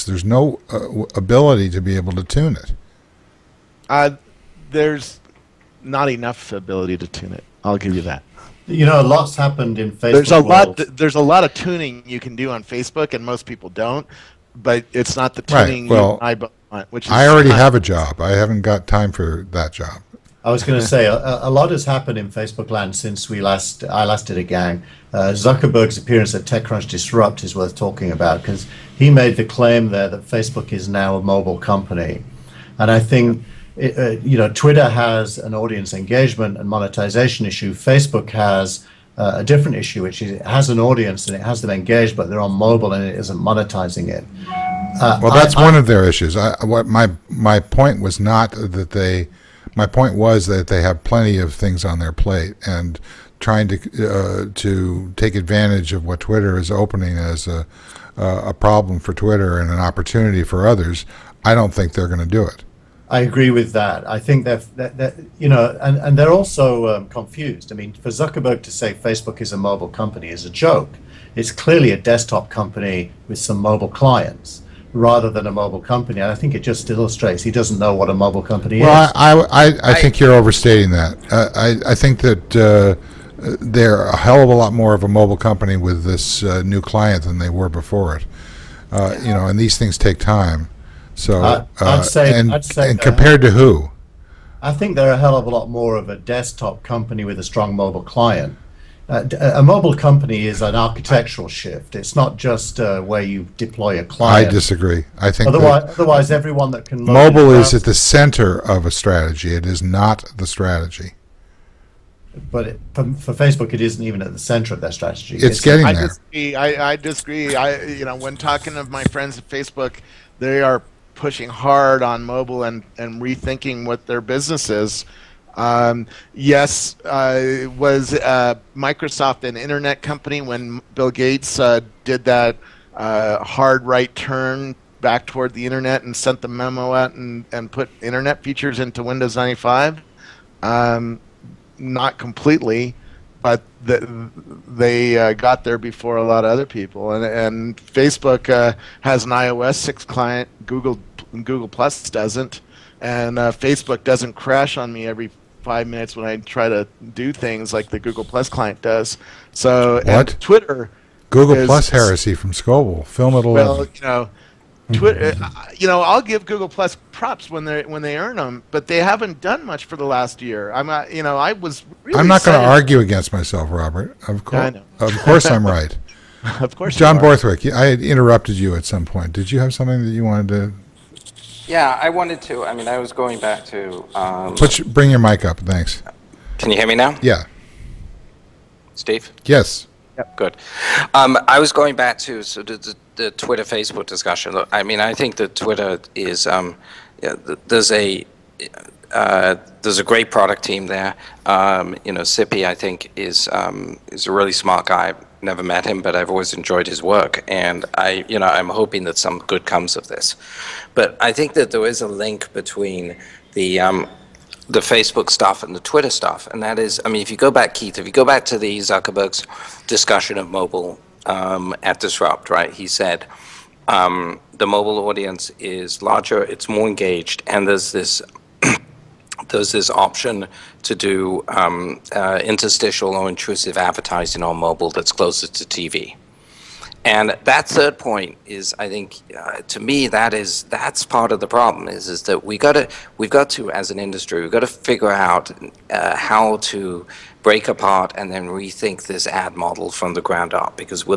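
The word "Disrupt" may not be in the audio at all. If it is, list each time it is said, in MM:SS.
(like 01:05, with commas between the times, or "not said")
00:26, 03:41.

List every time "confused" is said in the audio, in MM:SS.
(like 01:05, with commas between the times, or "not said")
01:07.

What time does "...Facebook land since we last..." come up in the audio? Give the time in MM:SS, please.
00:22.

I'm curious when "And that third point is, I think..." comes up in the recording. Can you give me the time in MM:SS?
03:57.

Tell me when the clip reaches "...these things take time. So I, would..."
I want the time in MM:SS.
01:29.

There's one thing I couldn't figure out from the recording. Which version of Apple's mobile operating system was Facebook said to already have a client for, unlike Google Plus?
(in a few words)
iOS 6.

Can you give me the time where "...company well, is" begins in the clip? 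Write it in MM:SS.
01:18.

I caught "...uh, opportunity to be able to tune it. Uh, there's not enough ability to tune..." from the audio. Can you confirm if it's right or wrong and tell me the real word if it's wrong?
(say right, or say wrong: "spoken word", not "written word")
wrong: "ability", not "opportunity".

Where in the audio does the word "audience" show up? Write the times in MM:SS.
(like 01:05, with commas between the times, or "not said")
00:35, 00:40, 03:45.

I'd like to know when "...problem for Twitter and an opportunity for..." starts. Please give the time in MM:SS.
00:58.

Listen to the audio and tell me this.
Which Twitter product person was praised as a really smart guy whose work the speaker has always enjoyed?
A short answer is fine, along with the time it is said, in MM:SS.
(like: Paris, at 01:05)
Sippey, at 03:22.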